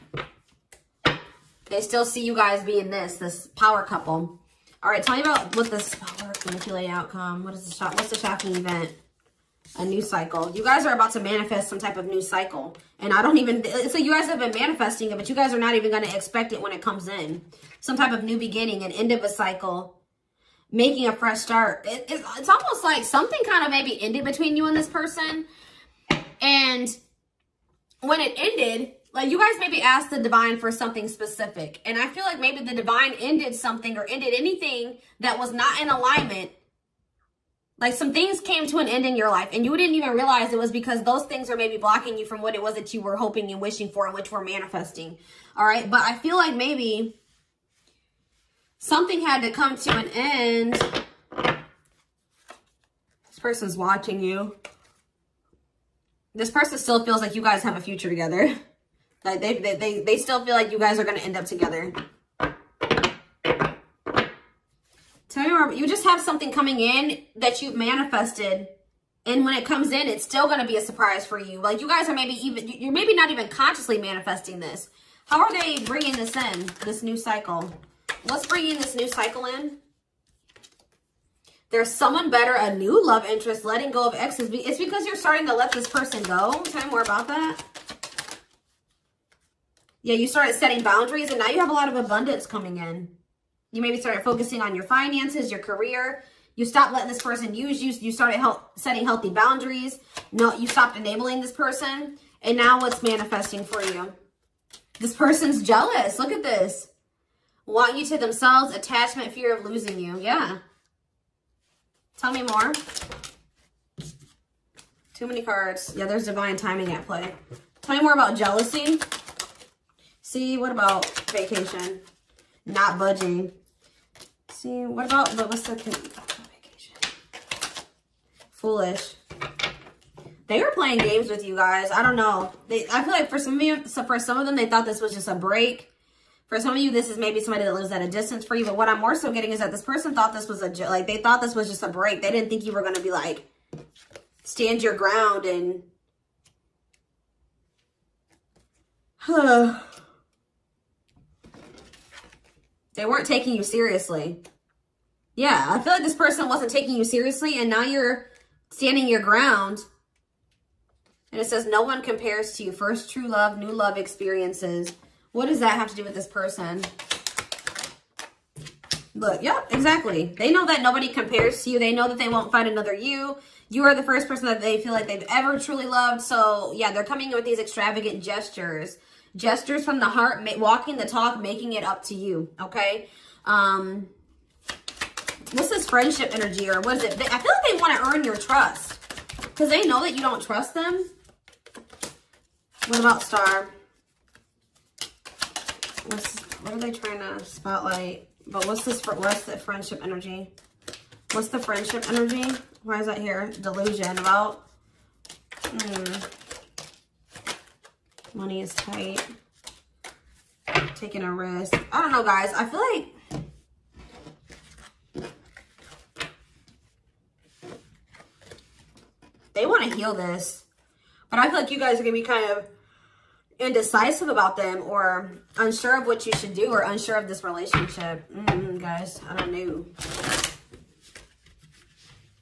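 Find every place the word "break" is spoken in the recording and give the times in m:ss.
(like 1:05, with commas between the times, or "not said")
2:15, 2:21.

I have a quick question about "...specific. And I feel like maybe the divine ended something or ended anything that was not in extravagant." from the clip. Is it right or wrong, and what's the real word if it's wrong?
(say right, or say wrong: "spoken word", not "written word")
wrong: "alignment", not "extravagant".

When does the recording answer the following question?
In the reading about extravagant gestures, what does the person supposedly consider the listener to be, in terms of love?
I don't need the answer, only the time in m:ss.
2:42.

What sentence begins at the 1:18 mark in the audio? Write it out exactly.
Let's bring in this new cycle in.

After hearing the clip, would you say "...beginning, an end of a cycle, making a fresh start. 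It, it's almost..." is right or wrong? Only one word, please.
right.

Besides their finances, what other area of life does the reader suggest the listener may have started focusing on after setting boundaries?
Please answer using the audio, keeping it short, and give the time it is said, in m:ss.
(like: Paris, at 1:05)
career, at 1:35.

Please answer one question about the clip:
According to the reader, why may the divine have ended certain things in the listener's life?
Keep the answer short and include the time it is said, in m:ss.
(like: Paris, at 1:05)
blocking you, at 0:41.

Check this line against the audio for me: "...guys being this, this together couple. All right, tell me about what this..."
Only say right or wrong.
wrong.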